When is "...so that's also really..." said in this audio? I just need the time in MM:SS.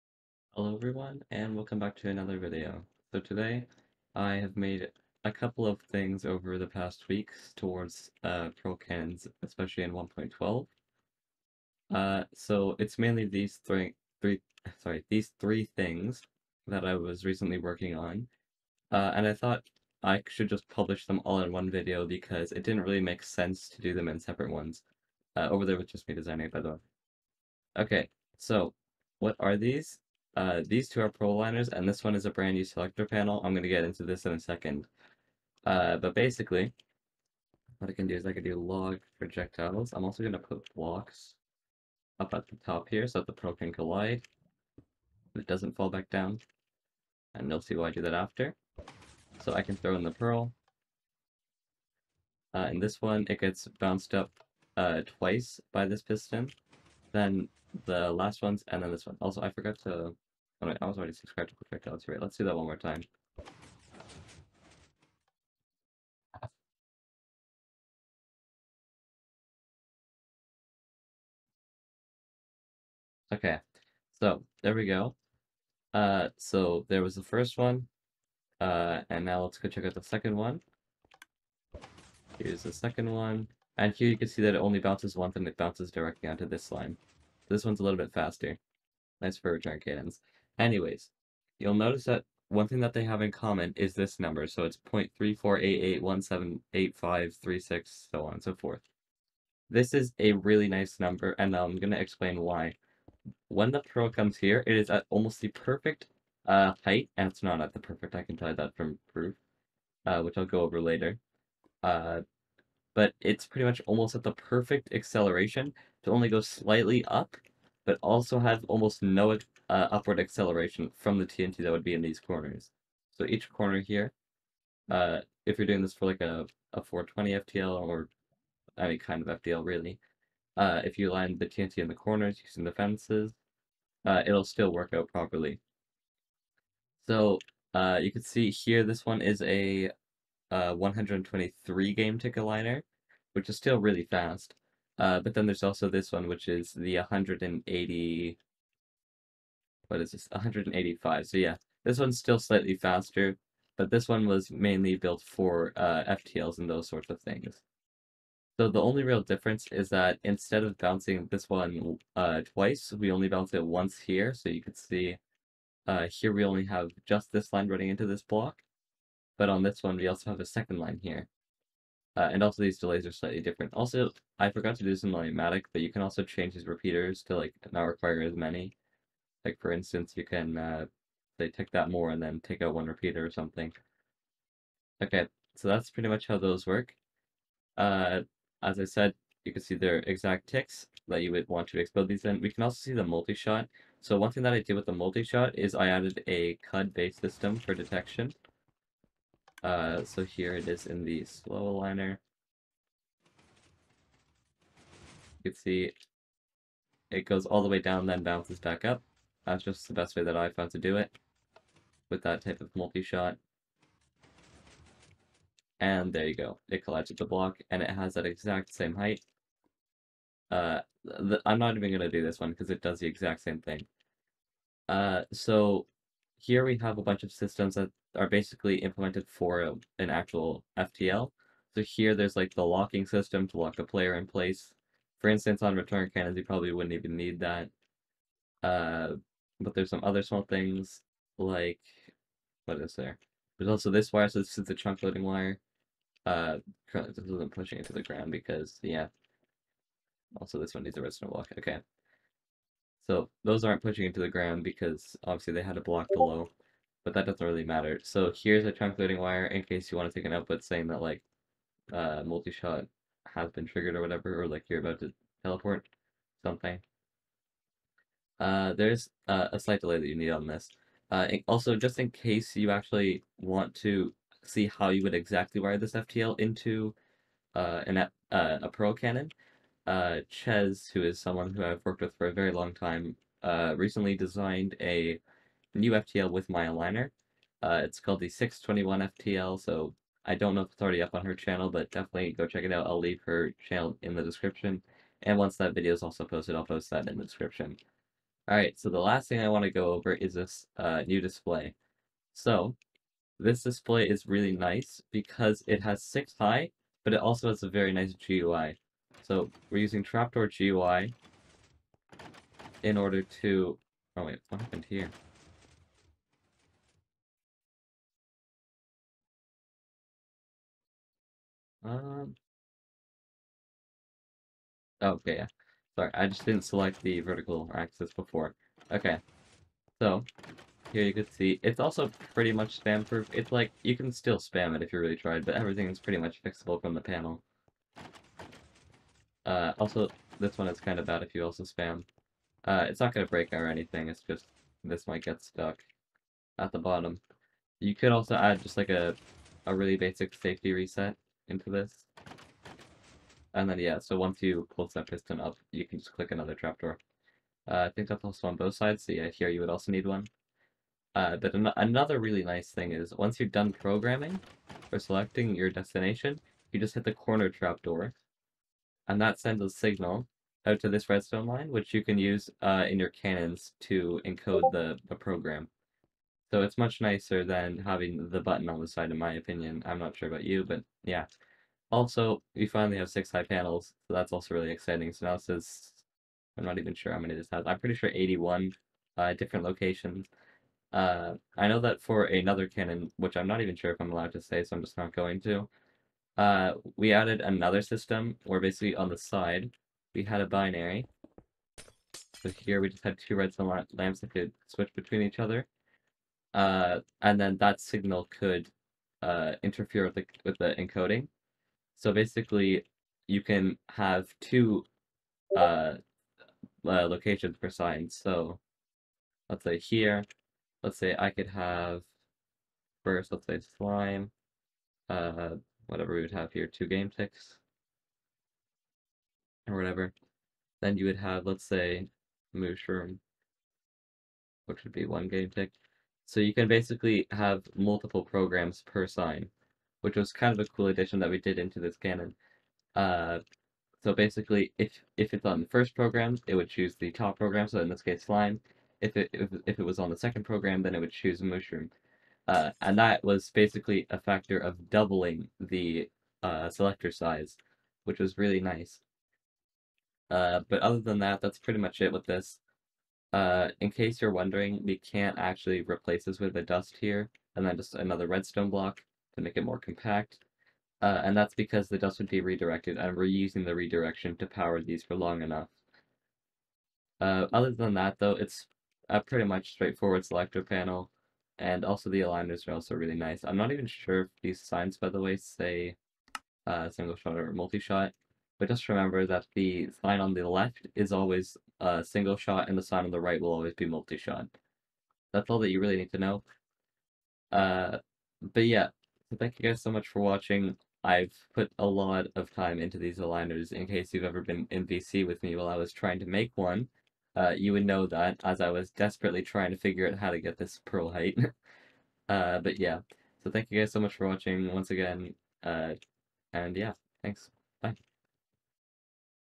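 06:24.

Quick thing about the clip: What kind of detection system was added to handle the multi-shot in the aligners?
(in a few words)
BUD-based system.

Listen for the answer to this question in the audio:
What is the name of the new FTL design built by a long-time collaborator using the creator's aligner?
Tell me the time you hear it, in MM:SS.
04:48.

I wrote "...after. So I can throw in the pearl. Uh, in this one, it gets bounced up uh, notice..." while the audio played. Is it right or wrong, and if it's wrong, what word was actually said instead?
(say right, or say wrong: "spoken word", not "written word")
wrong: "twice", not "notice".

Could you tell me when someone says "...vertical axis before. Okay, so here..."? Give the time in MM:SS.
05:27.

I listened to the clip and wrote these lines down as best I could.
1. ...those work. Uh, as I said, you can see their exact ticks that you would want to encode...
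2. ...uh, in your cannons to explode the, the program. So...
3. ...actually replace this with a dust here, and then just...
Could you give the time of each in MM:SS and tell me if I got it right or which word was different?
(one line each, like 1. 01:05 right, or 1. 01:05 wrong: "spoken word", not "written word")
1. 03:06 wrong: "explode", not "encode"
2. 06:12 wrong: "encode", not "explode"
3. 07:45 right.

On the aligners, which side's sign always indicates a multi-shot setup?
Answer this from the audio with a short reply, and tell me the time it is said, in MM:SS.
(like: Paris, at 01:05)
the right, at 08:12.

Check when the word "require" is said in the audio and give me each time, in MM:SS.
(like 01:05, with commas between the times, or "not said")
02:57.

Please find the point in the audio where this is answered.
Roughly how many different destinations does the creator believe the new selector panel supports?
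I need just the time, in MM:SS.
06:28.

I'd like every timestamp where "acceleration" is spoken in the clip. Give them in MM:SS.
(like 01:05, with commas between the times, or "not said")
01:54, 02:00.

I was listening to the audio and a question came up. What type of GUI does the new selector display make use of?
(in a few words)
Trapdoor GUI.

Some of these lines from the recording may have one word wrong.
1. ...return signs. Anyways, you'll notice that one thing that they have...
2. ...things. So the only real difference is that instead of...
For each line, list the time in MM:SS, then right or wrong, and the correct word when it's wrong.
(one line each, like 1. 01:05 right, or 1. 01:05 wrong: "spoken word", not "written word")
1. 01:29 wrong: "cannons", not "signs"
2. 02:37 right.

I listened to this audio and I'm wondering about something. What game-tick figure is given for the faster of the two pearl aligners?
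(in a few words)
123.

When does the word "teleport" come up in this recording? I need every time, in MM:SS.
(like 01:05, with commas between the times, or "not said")
04:25.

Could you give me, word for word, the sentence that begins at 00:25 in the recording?
Uh, over there was just me designing, by the way.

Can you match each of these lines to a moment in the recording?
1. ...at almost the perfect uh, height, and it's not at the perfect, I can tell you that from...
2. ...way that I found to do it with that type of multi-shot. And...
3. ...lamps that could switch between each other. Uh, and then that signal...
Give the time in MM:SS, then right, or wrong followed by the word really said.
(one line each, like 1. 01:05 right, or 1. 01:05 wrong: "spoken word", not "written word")
1. 01:44 right
2. 03:30 right
3. 06:43 right.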